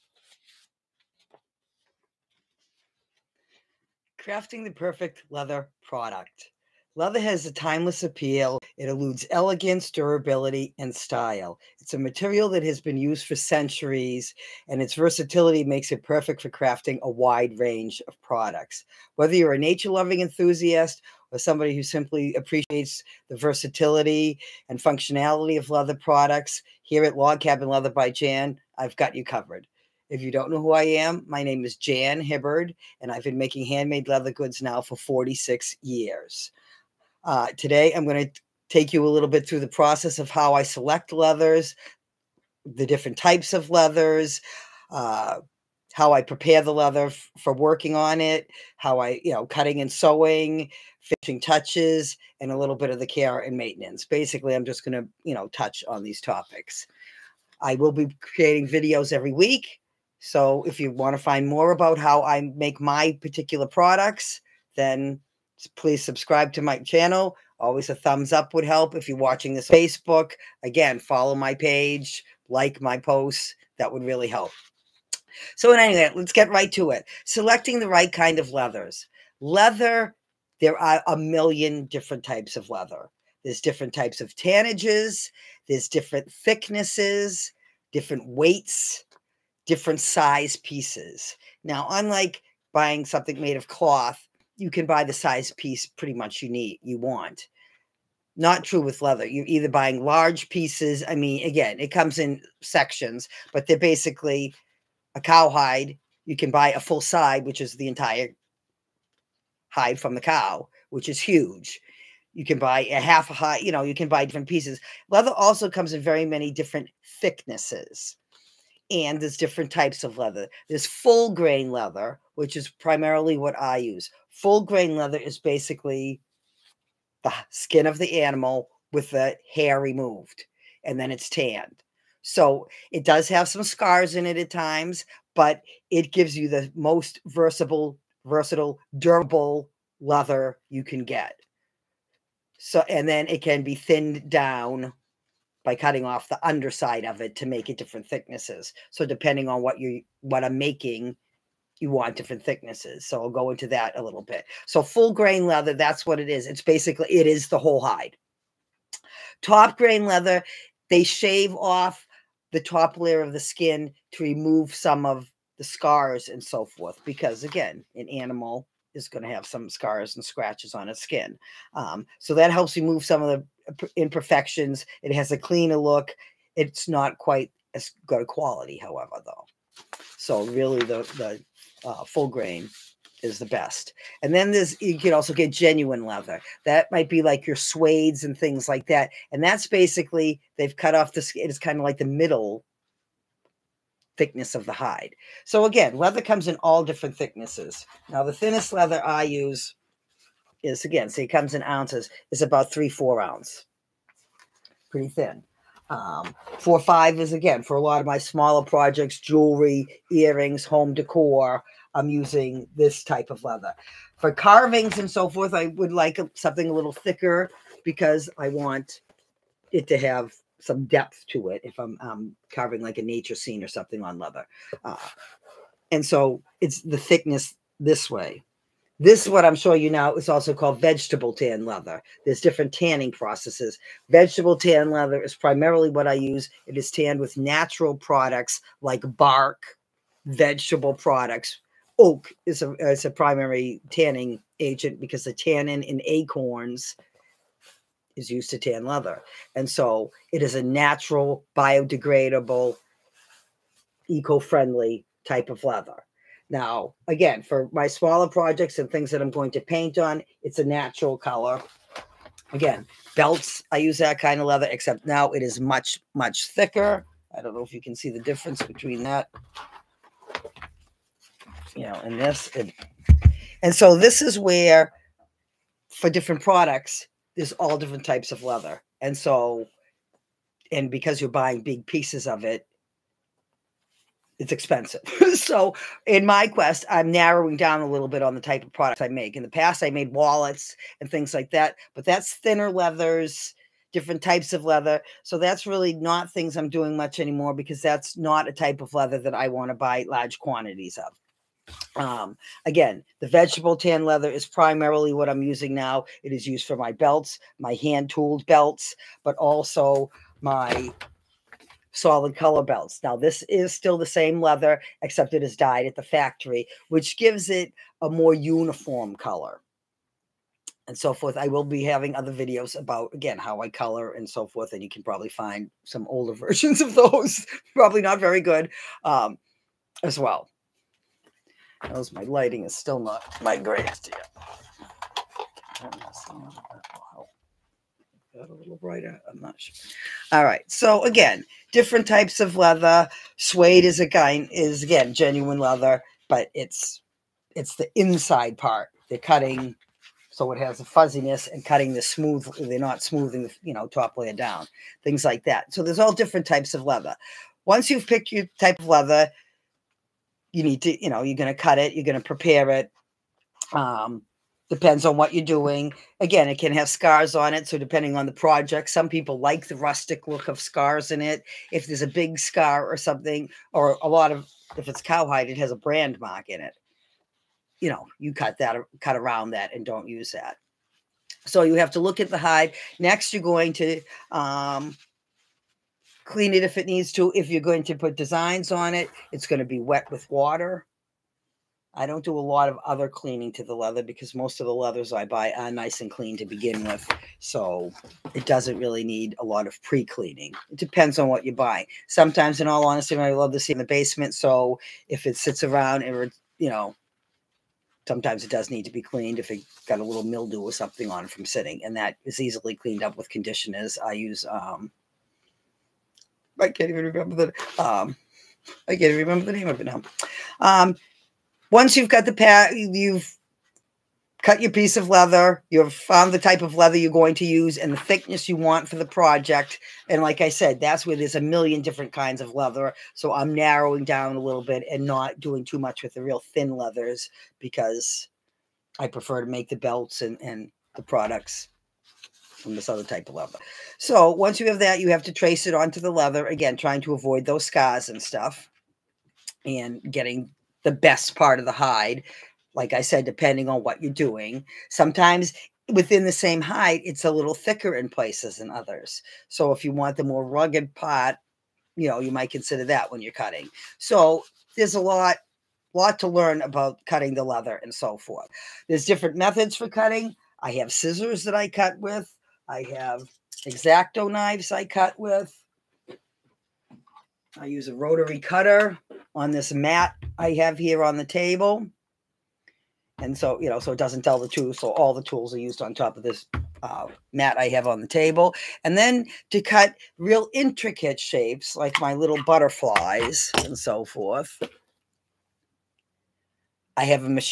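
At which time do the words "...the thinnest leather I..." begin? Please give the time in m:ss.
3:18.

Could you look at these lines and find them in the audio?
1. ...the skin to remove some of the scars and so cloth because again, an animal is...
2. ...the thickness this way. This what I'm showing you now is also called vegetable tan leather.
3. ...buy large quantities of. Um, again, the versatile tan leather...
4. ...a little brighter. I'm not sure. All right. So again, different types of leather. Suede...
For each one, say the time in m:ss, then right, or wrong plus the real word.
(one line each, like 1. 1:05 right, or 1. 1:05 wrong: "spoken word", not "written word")
1. 2:43 wrong: "forth", not "cloth"
2. 3:46 right
3. 4:59 wrong: "vegetable", not "versatile"
4. 5:38 right.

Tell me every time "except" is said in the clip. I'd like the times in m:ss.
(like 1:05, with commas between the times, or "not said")
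4:24, 5:15.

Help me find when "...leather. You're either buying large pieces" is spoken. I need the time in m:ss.
1:39.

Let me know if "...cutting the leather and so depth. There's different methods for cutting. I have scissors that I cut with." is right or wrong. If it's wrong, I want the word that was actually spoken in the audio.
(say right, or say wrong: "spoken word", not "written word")
wrong: "forth", not "depth".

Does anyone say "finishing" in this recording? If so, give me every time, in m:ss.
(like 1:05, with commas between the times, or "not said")
0:51.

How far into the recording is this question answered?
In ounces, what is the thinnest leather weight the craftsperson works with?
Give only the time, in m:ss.
3:22.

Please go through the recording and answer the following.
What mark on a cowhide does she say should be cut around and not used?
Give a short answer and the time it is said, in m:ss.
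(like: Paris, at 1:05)
Brand mark, at 6:15.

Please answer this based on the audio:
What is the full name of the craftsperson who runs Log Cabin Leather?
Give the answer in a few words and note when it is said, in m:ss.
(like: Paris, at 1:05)
Jan Hibbard, at 0:31.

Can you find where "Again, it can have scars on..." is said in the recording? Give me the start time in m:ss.
6:06.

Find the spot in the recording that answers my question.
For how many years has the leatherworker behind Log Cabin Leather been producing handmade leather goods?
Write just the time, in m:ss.
0:34.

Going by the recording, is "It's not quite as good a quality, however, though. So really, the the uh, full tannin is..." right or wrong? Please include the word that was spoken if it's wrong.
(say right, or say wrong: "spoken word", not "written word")
wrong: "grain", not "tannin".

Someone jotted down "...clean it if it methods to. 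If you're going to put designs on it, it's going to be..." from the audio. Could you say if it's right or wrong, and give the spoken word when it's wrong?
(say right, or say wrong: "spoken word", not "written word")
wrong: "needs", not "methods".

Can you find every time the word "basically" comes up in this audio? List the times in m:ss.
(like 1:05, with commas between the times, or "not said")
0:54, 1:43, 2:05, 2:36, 3:09.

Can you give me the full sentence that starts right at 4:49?
In the past, I made wallets and things like that, but that's thinner leathers, different types of leather.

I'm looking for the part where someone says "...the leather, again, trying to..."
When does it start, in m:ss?
7:26.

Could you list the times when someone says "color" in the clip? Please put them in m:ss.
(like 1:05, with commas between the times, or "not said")
4:21, 5:12, 5:19, 5:23.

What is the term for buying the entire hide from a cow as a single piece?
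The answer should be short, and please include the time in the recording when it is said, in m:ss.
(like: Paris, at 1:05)
Full side, at 1:46.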